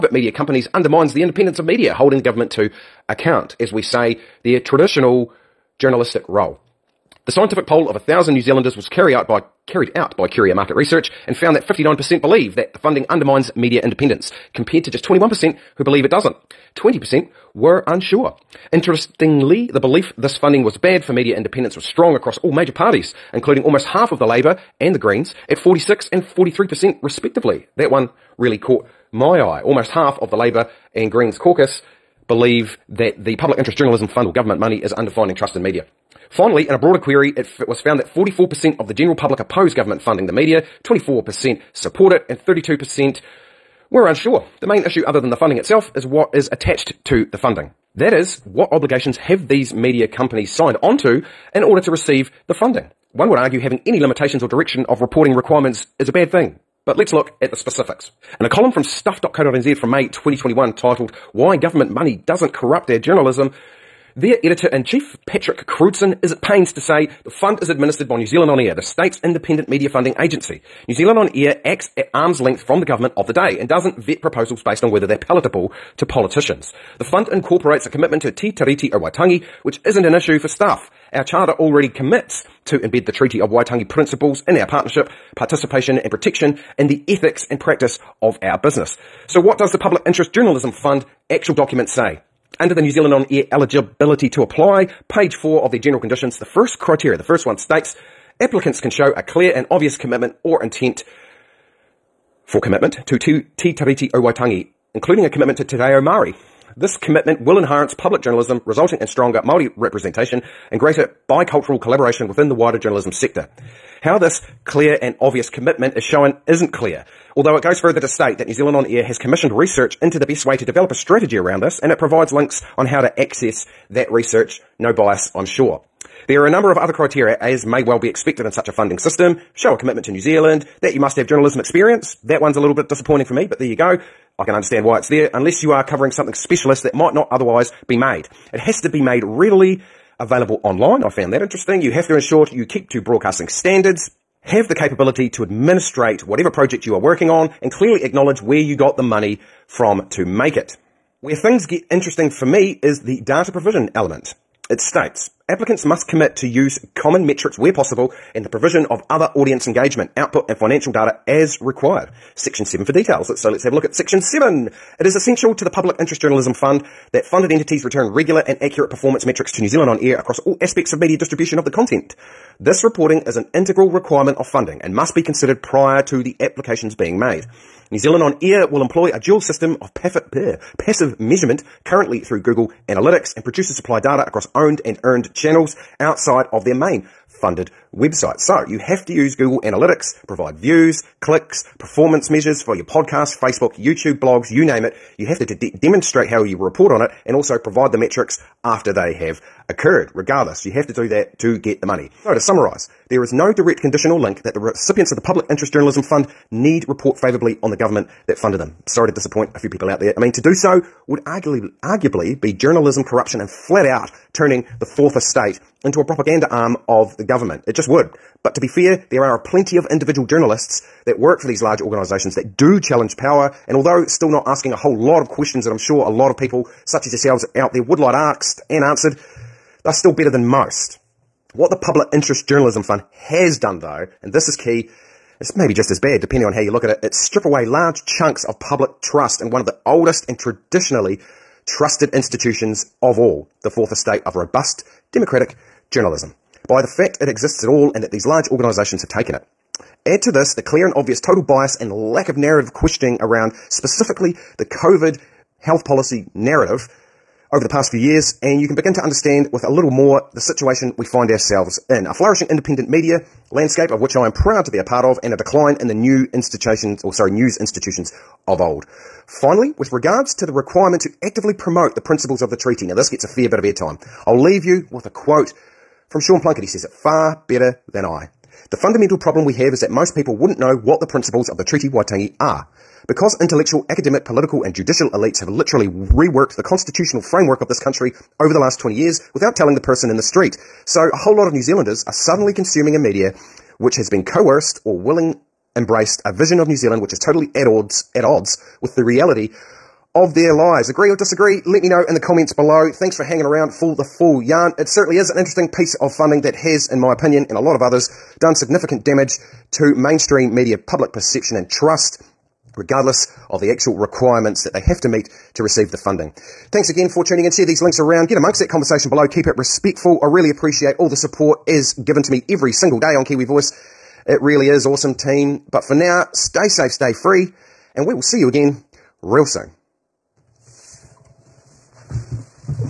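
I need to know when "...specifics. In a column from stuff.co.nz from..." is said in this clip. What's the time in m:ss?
0:57.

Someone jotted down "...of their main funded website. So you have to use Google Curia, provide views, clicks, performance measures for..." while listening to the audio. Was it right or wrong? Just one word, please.
wrong.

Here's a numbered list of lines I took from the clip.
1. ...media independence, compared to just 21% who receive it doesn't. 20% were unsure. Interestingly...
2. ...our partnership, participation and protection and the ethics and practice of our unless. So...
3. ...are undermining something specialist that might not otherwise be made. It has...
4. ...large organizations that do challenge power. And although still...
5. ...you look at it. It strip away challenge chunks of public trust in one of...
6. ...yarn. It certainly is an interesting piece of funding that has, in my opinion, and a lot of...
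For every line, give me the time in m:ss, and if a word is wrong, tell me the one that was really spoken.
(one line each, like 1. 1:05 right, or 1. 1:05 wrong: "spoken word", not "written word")
1. 0:13 wrong: "believe", not "receive"
2. 1:24 wrong: "business", not "unless"
3. 2:15 wrong: "covering", not "undermining"
4. 3:41 right
5. 3:56 wrong: "large", not "challenge"
6. 5:04 right.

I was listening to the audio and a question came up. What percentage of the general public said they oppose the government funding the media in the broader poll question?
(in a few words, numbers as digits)
44%.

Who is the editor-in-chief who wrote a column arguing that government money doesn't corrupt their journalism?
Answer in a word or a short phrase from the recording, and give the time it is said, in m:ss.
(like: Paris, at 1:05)
Patrick Crewdson, at 1:05.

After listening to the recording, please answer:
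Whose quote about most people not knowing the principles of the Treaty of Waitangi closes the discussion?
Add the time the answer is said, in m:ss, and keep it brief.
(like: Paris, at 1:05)
Sean Plunket, at 4:36.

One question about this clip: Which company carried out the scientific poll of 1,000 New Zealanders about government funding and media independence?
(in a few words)
Curia Market Research.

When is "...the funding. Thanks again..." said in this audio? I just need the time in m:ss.
5:15.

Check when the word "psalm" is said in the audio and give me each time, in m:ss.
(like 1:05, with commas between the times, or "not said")
not said.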